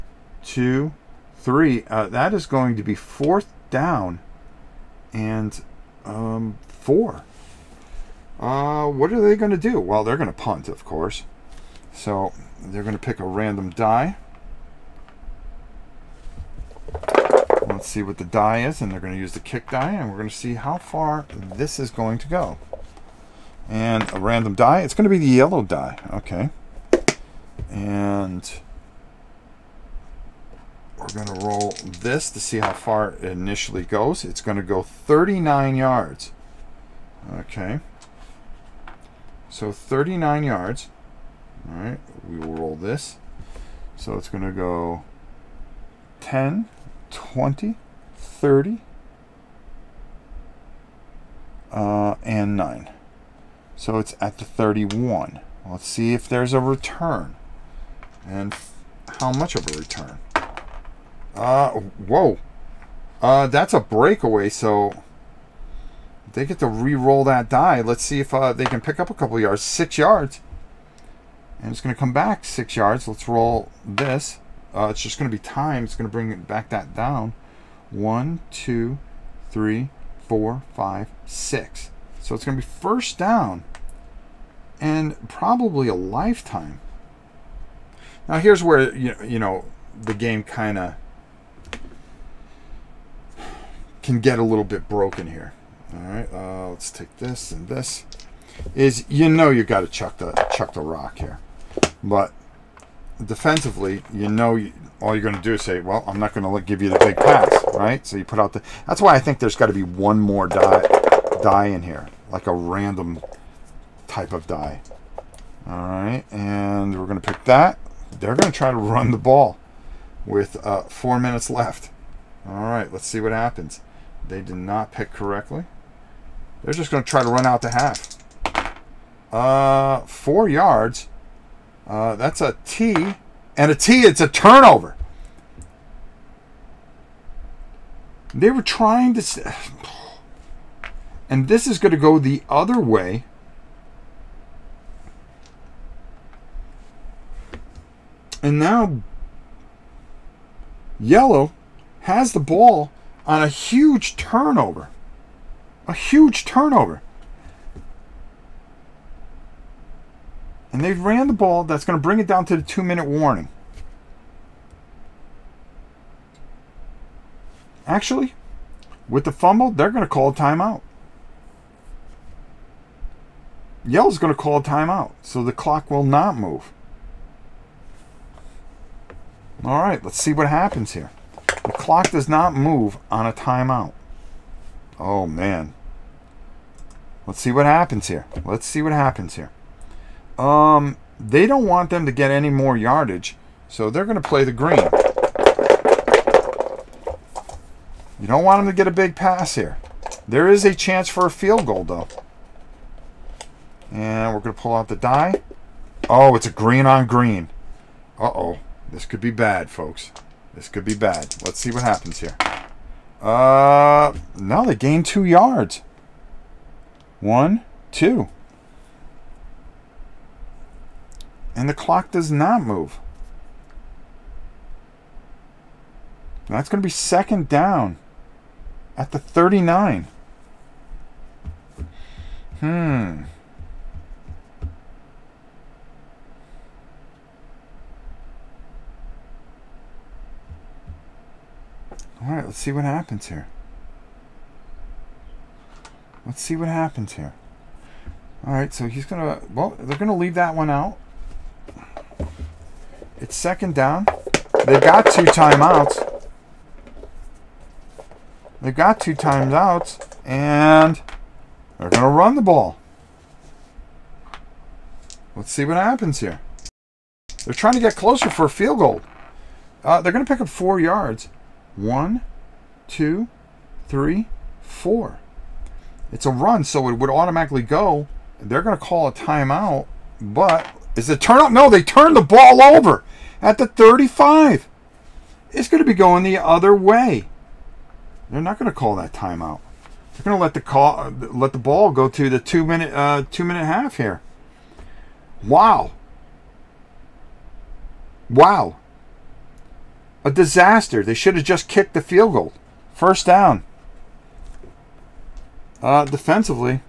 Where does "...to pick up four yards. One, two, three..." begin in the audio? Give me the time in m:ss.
4:30.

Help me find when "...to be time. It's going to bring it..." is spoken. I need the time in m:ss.
1:15.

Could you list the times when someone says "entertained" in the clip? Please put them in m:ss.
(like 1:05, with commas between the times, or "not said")
not said.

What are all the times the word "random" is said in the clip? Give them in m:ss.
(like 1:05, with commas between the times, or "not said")
0:13, 0:24, 1:52.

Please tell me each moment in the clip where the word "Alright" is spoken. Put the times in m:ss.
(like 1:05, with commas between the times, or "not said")
4:02, 4:08.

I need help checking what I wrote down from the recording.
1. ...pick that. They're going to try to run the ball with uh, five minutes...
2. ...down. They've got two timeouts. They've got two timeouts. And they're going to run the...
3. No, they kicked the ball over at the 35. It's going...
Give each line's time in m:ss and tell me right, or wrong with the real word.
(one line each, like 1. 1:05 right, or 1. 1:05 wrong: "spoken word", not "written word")
1. 1:57 wrong: "four", not "five"
2. 4:13 right
3. 4:41 wrong: "turned", not "kicked".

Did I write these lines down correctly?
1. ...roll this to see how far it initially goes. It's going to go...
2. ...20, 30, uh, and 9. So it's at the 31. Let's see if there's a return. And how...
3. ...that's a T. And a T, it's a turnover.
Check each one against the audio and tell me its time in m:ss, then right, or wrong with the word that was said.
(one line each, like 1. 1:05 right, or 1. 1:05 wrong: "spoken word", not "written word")
1. 0:31 right
2. 0:47 right
3. 2:12 right.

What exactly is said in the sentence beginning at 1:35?
All right, uh, let's take this and this.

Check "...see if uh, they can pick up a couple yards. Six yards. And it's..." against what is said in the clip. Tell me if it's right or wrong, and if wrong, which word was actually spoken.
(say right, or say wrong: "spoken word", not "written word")
right.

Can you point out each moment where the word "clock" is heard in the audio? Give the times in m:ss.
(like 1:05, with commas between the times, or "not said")
2:55, 3:01, 3:41.